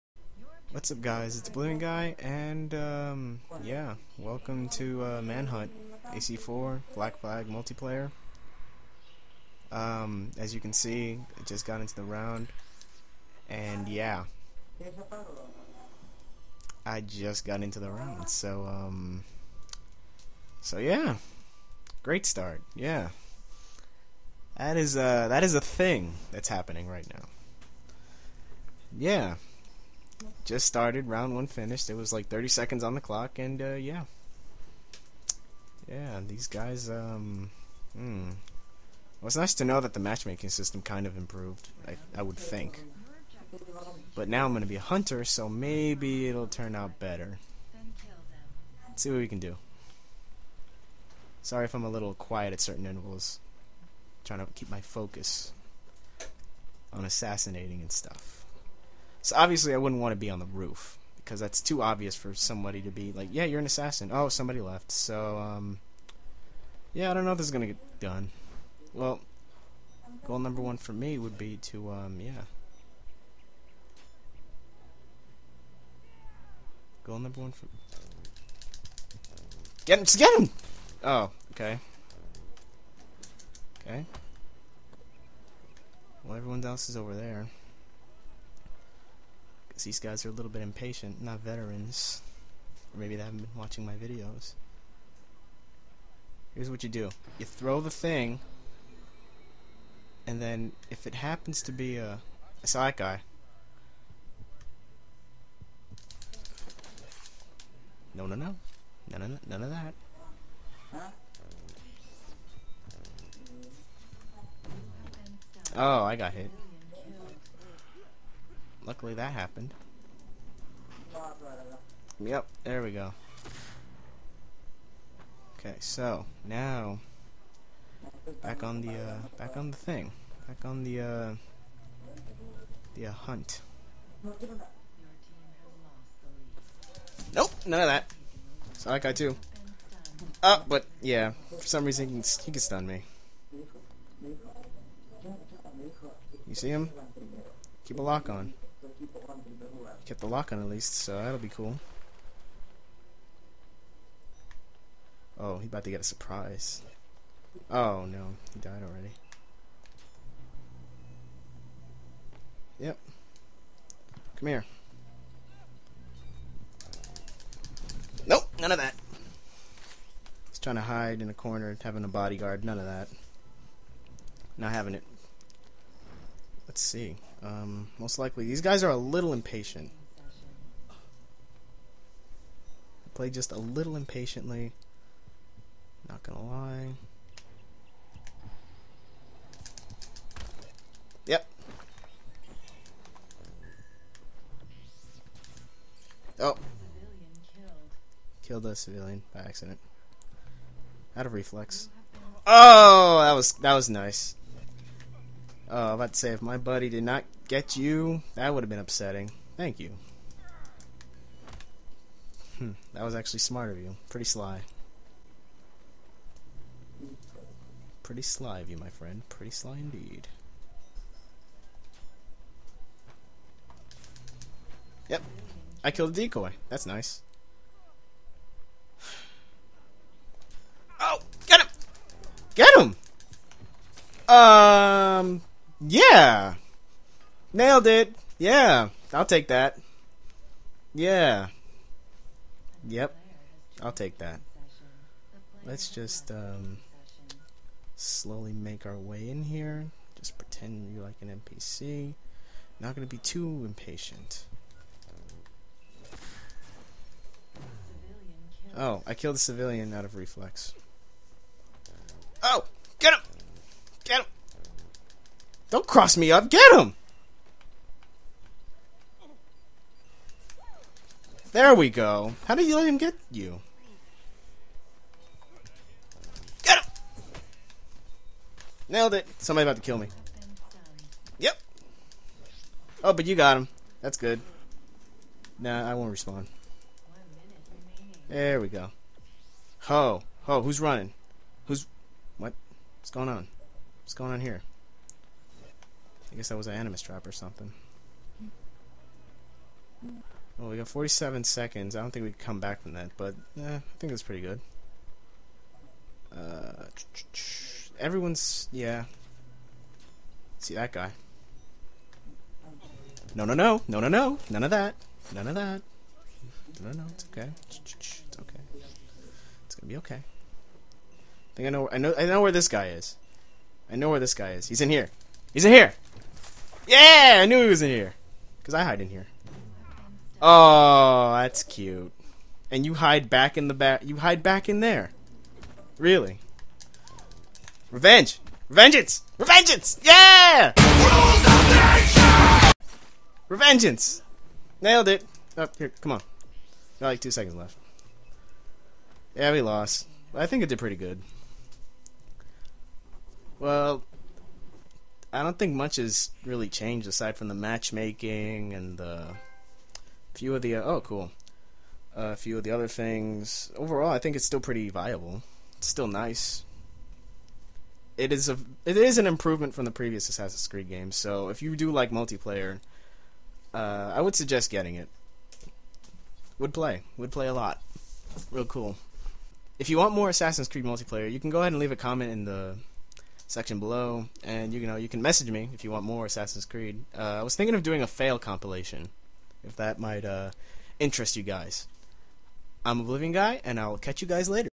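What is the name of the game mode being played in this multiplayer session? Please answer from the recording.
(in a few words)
Manhunt.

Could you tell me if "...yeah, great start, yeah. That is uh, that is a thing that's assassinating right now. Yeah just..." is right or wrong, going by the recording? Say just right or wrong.
wrong.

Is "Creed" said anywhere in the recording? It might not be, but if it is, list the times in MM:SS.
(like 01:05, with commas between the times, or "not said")
06:10, 06:20, 06:26.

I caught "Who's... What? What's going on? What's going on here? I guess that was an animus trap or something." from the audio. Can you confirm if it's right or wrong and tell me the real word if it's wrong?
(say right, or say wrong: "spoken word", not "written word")
right.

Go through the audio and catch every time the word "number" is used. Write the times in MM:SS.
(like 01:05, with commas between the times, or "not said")
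01:10, 01:17.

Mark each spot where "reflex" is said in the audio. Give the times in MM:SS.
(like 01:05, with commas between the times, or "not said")
03:21, 04:20.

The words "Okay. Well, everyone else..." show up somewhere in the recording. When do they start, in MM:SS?
01:23.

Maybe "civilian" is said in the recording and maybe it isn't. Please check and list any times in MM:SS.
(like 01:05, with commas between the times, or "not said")
03:18, 04:19.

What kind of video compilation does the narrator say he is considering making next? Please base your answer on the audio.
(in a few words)
Fail compilation.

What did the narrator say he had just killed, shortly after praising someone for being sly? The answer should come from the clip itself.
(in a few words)
A decoy.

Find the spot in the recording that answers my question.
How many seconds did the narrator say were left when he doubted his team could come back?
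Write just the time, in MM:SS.
05:00.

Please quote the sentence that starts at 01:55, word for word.
Oh, I got hit luckily that happened.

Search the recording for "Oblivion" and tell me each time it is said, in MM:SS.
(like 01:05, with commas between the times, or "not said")
00:01, 06:33.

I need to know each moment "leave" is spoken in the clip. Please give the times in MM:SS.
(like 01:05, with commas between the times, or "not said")
06:21.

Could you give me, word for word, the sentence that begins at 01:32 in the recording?
Or maybe they haven't been watching my videos.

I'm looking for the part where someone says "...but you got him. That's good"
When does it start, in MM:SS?
04:43.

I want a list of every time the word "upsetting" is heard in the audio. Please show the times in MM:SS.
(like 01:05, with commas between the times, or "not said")
03:28.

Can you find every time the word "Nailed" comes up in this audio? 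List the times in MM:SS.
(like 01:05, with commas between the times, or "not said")
03:57, 04:38, 05:44.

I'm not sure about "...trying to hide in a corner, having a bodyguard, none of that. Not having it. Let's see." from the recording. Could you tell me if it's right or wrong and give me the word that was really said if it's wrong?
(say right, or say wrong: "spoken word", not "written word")
right.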